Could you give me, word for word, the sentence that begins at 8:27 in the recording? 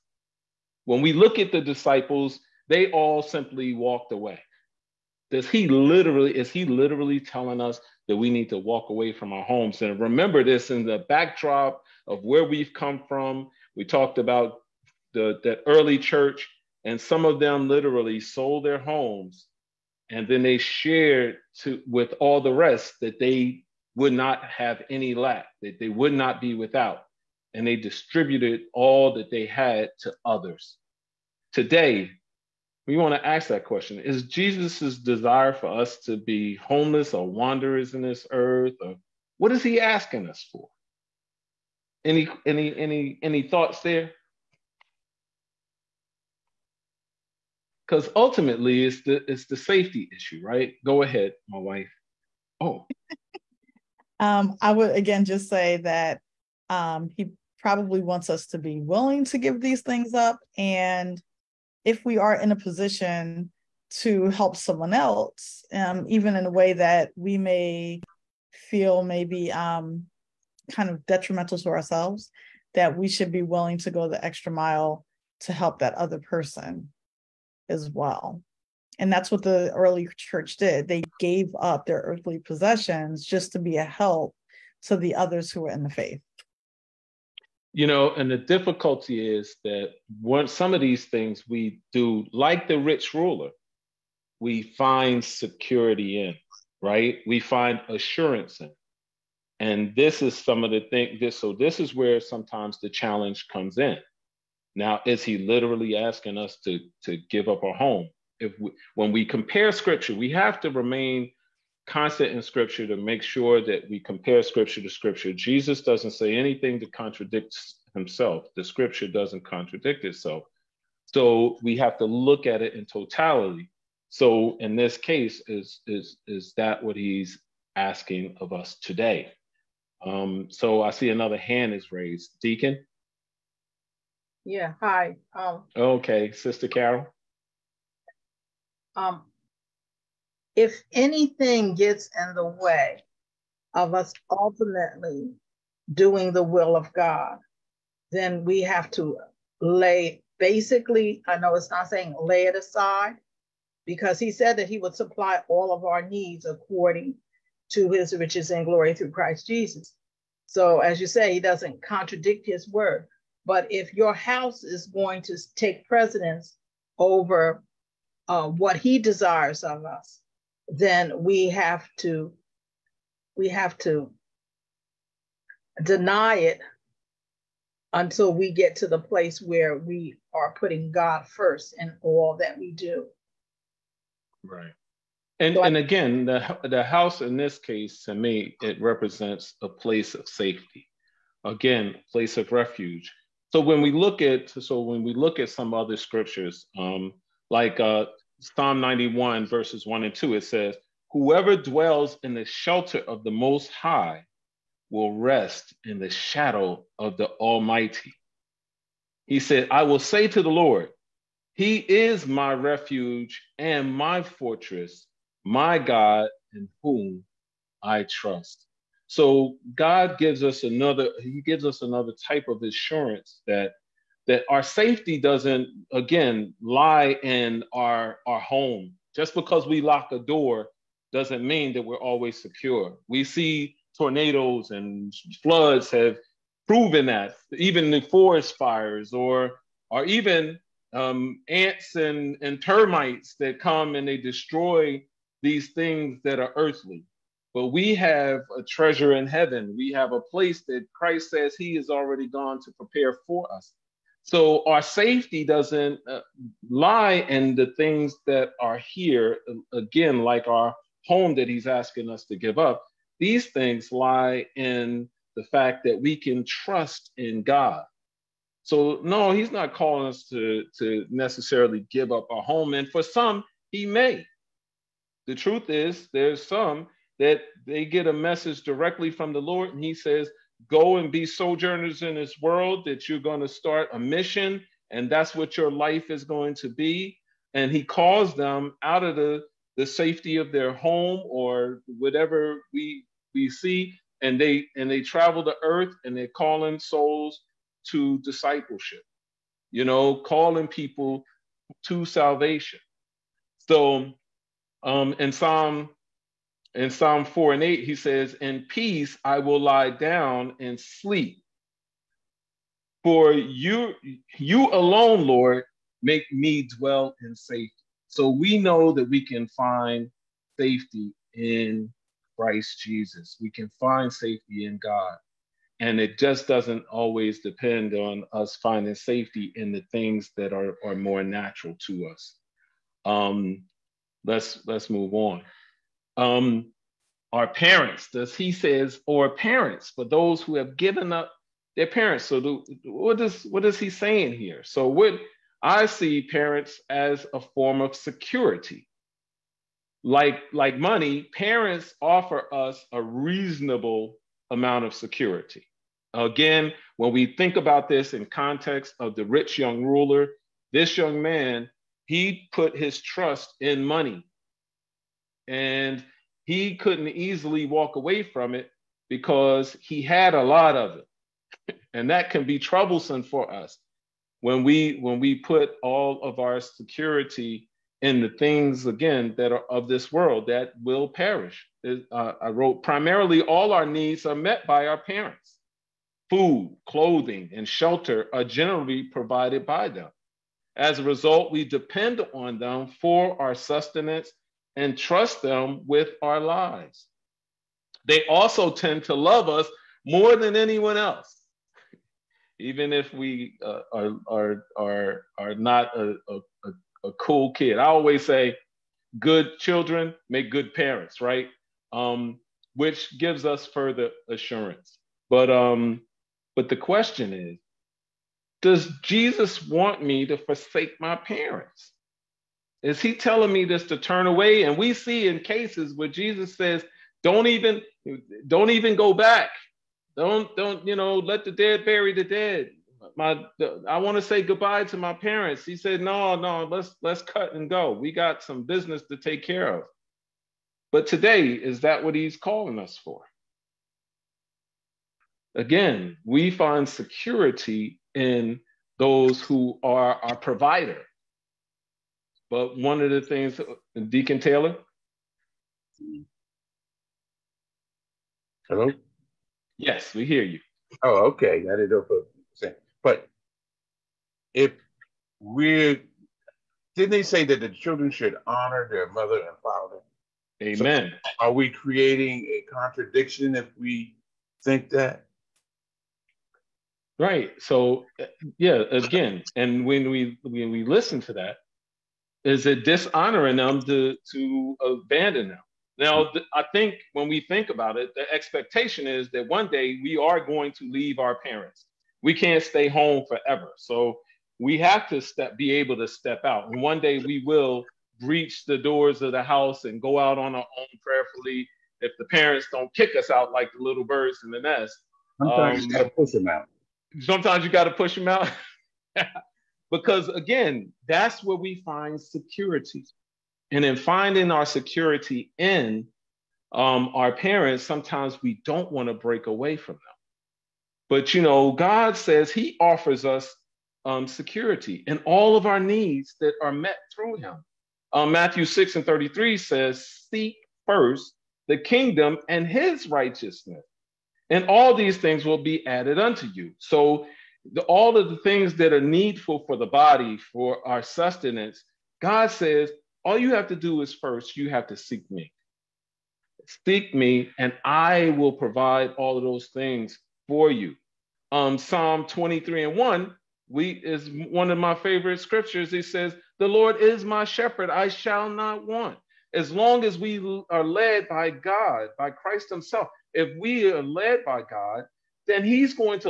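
Sometimes you gotta push them out.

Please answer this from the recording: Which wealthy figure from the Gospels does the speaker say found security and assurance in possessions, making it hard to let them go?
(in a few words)
The rich ruler.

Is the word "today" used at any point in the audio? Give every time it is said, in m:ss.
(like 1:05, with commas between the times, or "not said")
0:31, 2:08, 7:21.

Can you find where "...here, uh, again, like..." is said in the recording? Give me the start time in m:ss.
4:18.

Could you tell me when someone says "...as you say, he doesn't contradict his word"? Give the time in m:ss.
2:40.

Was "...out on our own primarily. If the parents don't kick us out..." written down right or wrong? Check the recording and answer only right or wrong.
wrong.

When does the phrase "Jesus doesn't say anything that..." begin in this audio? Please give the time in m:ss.
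1:55.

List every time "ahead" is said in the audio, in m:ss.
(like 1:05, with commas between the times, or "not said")
0:51.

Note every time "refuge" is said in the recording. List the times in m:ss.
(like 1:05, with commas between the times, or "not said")
3:12, 3:32.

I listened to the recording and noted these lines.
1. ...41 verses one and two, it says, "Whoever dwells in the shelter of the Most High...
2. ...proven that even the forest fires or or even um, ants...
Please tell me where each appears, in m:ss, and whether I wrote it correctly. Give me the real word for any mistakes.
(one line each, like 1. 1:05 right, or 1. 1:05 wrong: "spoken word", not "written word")
1. 3:18 wrong: "91", not "41"
2. 3:56 right.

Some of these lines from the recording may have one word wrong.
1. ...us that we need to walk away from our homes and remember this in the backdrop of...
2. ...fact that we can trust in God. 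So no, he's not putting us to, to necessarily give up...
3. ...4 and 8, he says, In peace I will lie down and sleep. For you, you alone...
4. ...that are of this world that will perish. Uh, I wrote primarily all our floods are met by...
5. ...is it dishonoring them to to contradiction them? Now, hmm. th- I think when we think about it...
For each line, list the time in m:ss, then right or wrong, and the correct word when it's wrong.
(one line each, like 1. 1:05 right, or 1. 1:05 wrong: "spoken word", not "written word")
1. 0:07 right
2. 4:25 wrong: "calling", not "putting"
3. 5:07 right
4. 6:19 wrong: "needs", not "floods"
5. 8:02 wrong: "abandon", not "contradiction".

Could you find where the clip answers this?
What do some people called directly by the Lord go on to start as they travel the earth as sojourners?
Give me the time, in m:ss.
4:43.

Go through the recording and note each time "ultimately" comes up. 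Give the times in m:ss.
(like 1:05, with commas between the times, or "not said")
0:48, 2:24.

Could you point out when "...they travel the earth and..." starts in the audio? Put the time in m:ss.
4:54.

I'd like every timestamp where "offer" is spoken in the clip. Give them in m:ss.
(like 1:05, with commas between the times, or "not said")
5:52, 8:42.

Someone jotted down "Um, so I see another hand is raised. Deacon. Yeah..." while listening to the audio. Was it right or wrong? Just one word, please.
right.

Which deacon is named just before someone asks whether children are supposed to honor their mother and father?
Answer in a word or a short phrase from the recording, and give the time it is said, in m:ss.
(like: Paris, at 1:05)
Deacon Taylor, at 7:34.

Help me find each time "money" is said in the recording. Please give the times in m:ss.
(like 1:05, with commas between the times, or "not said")
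5:50, 6:03.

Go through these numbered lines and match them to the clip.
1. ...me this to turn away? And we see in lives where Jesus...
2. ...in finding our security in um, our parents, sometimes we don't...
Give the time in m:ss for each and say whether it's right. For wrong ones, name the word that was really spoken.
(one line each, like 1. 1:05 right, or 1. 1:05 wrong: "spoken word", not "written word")
1. 7:03 wrong: "cases", not "lives"
2. 8:33 right.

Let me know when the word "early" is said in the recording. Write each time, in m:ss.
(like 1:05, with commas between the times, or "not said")
0:15, 1:19.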